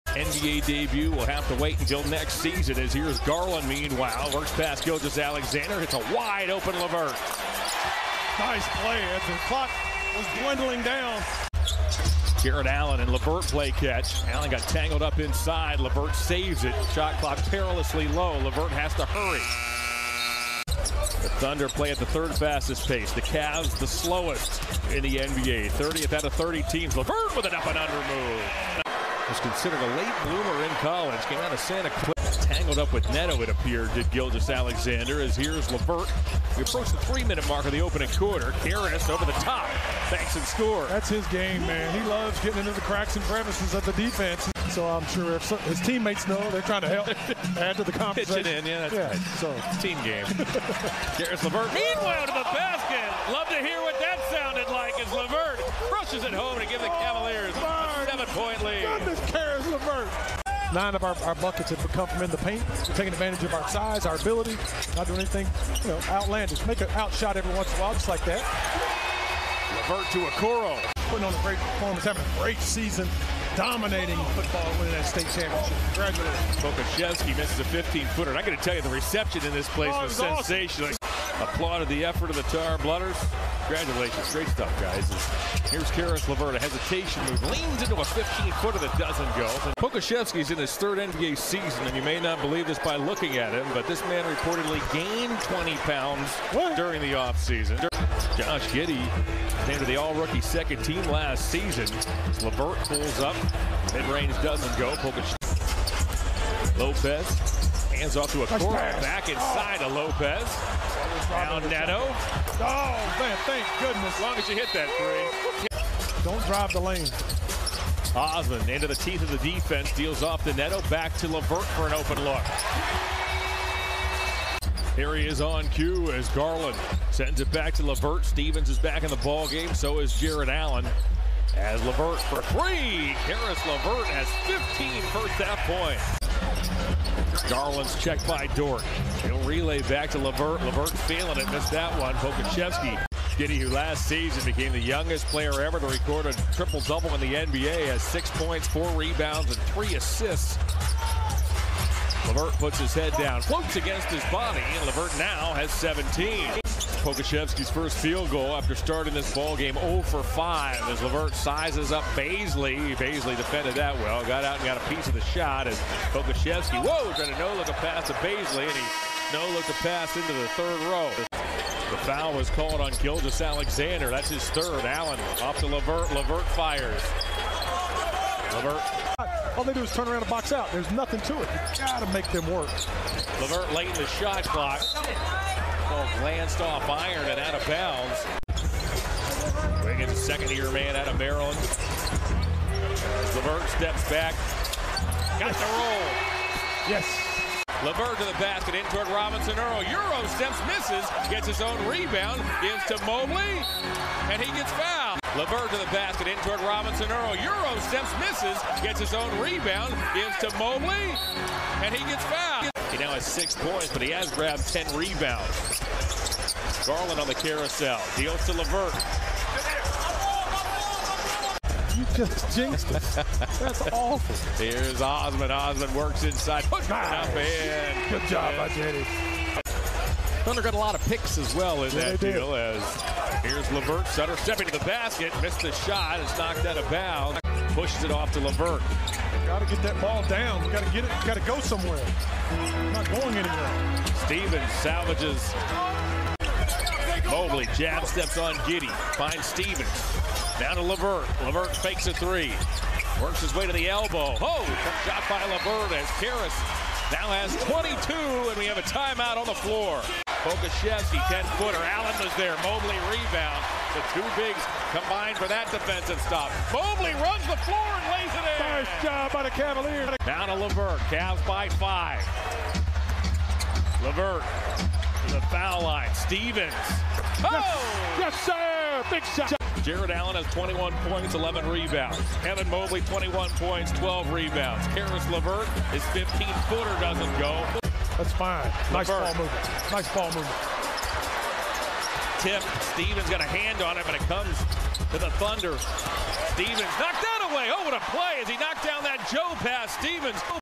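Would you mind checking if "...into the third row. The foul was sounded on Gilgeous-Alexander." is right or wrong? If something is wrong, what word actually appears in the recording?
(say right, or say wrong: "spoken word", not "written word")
wrong: "called", not "sounded".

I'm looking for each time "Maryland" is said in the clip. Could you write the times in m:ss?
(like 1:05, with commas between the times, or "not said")
3:11.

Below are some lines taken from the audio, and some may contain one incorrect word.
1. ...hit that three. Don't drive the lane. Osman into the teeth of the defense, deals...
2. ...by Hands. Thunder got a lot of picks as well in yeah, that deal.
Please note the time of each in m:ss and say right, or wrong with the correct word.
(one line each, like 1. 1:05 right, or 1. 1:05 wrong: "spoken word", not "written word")
1. 1:54 right
2. 3:48 wrong: "Jenny", not "Hands".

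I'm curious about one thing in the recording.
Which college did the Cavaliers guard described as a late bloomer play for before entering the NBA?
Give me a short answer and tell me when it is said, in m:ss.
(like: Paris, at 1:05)
Santa Clara, at 0:31.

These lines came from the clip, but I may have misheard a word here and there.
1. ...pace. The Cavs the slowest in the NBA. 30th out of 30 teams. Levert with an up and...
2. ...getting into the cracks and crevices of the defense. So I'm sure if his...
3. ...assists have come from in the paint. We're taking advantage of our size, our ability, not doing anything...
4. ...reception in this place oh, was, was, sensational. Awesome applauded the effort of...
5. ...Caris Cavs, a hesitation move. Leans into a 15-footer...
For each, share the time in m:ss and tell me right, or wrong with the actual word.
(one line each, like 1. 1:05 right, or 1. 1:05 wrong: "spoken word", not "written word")
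1. 0:22 right
2. 0:42 right
3. 1:01 wrong: "buckets", not "assists"
4. 1:18 right
5. 1:25 wrong: "LeVert", not "Cavs".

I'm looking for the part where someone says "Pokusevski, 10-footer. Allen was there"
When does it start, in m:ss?
4:20.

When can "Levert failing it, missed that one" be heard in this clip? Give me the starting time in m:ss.
2:20.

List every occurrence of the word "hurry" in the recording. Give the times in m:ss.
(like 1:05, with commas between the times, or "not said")
0:19.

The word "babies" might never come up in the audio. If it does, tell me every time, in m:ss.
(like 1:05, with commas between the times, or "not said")
not said.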